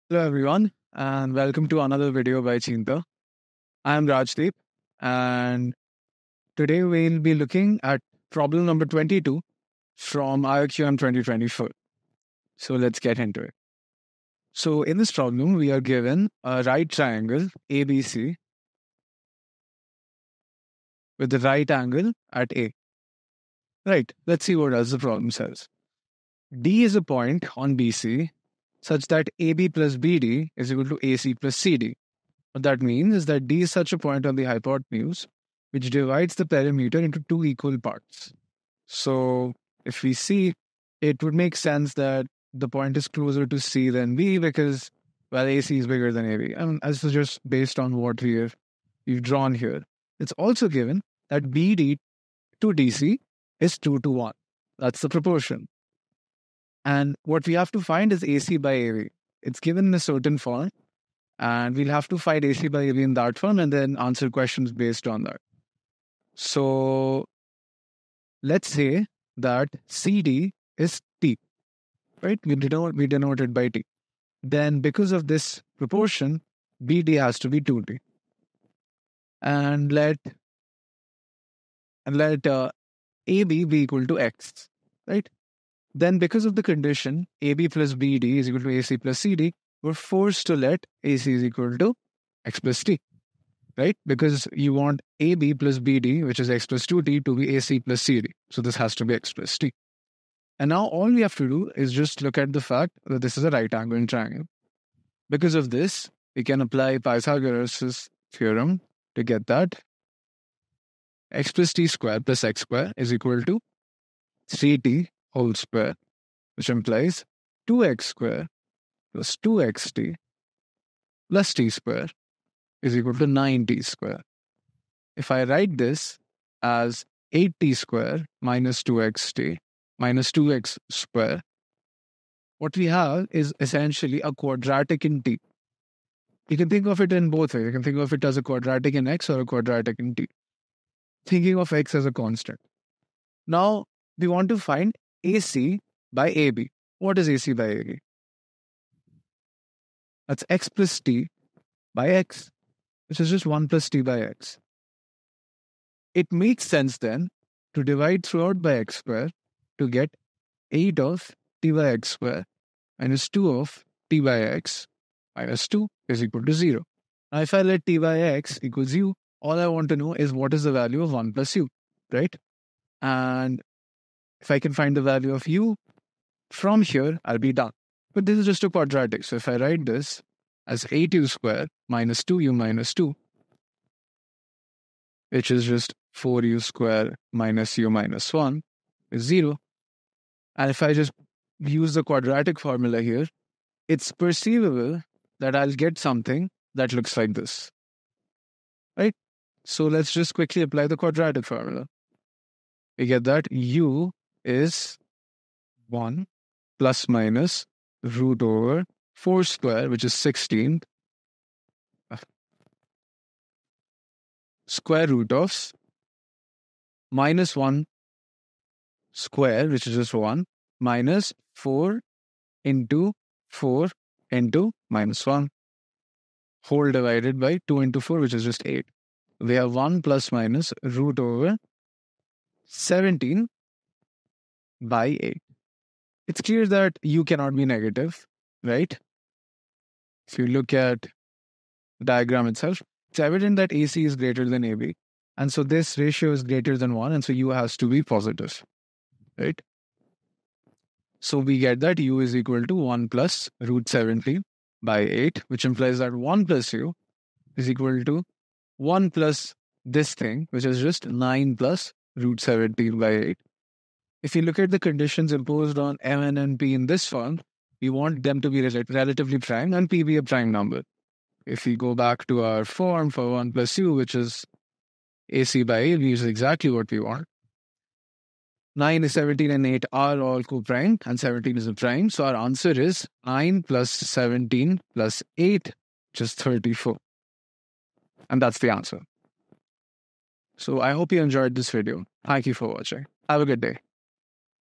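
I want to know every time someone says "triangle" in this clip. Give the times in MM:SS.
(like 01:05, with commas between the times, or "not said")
00:16, 01:44.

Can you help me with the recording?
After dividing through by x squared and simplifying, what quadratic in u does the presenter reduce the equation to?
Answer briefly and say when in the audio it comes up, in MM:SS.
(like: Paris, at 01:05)
4u² − u − 1 = 0, at 03:06.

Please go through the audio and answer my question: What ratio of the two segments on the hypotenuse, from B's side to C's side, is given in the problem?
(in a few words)
2 to 1.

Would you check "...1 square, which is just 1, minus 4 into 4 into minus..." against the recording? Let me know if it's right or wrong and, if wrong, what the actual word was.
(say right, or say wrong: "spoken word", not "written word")
right.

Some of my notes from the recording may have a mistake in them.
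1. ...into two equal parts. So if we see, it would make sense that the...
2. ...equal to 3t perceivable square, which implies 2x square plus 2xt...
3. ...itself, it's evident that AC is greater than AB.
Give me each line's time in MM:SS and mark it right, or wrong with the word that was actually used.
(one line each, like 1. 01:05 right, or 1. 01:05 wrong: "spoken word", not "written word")
1. 00:36 right
2. 01:53 wrong: "whole", not "perceivable"
3. 04:02 right.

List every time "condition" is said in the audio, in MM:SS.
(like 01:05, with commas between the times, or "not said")
01:26, 04:24.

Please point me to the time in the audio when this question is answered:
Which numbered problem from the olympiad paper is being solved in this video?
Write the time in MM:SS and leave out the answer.
00:08.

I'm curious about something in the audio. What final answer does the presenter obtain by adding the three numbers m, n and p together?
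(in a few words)
34.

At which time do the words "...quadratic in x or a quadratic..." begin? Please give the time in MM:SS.
02:18.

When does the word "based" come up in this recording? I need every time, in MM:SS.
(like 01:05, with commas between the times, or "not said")
00:47, 01:04.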